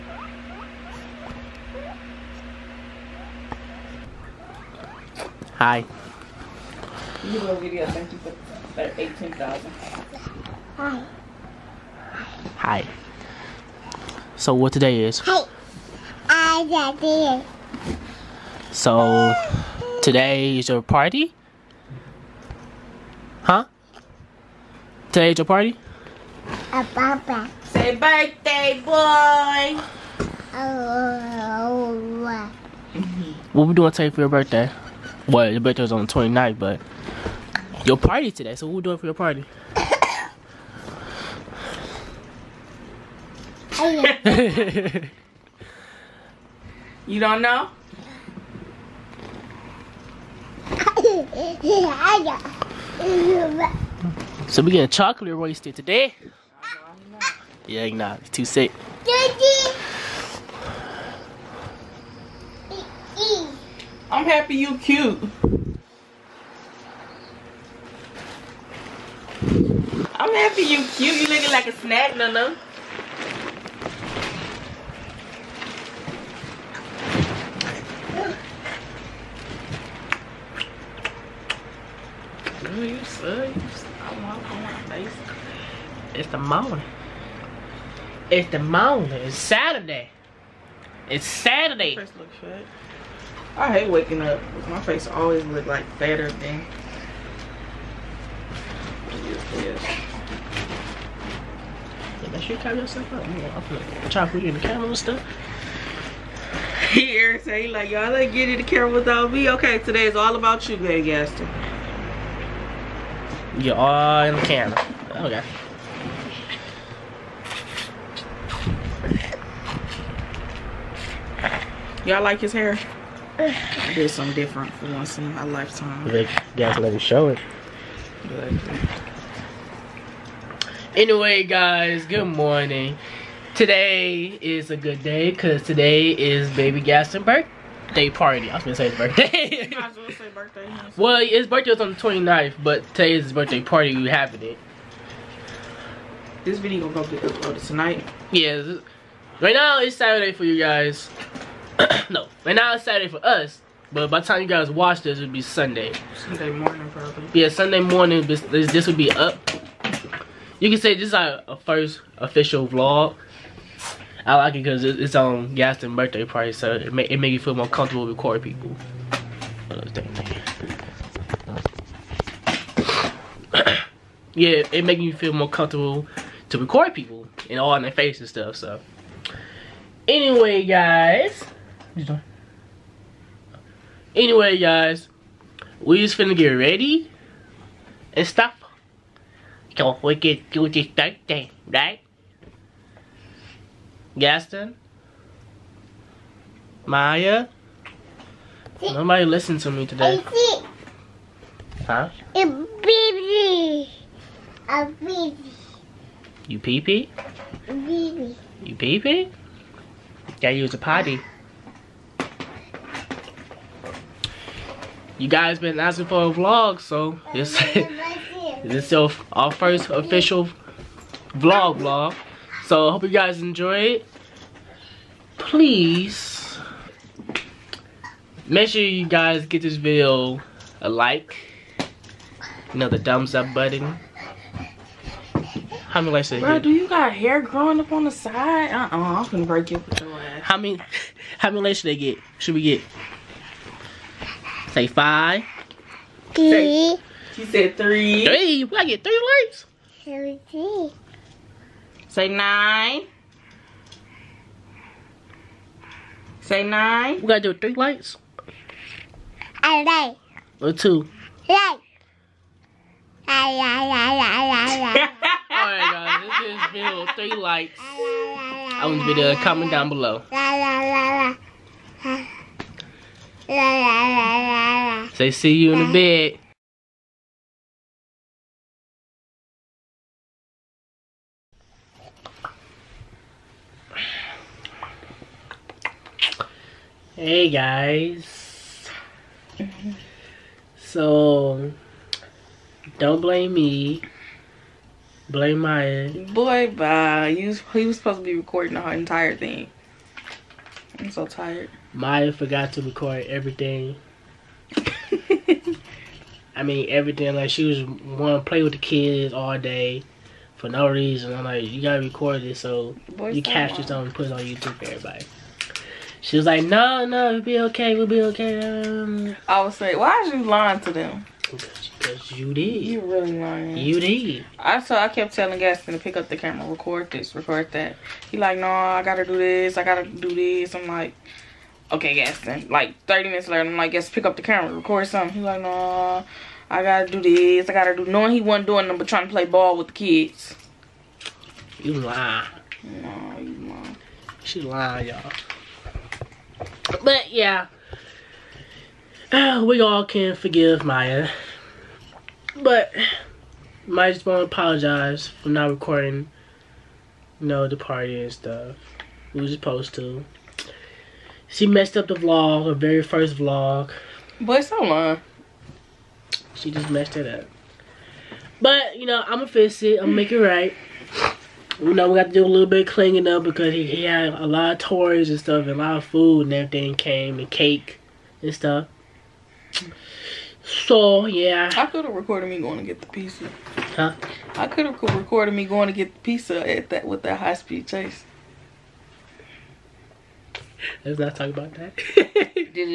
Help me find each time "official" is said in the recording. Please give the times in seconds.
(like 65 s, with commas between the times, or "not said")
162 s, 219 s.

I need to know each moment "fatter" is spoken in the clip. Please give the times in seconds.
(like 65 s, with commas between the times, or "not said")
95 s.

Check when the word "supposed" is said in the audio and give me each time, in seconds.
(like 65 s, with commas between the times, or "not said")
297 s, 359 s.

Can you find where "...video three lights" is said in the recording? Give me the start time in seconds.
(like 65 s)
266 s.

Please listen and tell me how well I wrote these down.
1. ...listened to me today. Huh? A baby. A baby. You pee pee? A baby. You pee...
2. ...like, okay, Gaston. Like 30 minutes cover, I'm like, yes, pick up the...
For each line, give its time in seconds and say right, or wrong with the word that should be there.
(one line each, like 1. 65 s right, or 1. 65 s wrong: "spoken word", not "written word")
1. 199 s right
2. 330 s wrong: "later", not "cover".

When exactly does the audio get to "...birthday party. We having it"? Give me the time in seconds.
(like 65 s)
143 s.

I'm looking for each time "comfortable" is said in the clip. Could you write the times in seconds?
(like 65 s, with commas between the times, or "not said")
167 s, 175 s.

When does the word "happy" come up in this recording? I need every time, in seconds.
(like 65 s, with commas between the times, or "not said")
64 s, 70 s.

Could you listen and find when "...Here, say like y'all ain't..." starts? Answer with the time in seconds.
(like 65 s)
106 s.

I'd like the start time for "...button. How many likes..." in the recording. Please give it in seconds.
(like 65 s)
233 s.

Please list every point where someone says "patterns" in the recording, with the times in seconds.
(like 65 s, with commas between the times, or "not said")
not said.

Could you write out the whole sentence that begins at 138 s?
I was gonna say his birthday.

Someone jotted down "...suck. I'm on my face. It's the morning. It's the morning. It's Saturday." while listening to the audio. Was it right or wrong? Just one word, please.
right.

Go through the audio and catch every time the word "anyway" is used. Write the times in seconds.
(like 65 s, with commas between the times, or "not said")
130 s, 180 s, 184 s.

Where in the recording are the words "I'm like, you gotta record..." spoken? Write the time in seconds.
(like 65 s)
311 s.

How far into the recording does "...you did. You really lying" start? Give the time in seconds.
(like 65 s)
322 s.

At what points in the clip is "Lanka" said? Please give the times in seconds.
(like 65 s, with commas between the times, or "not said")
not said.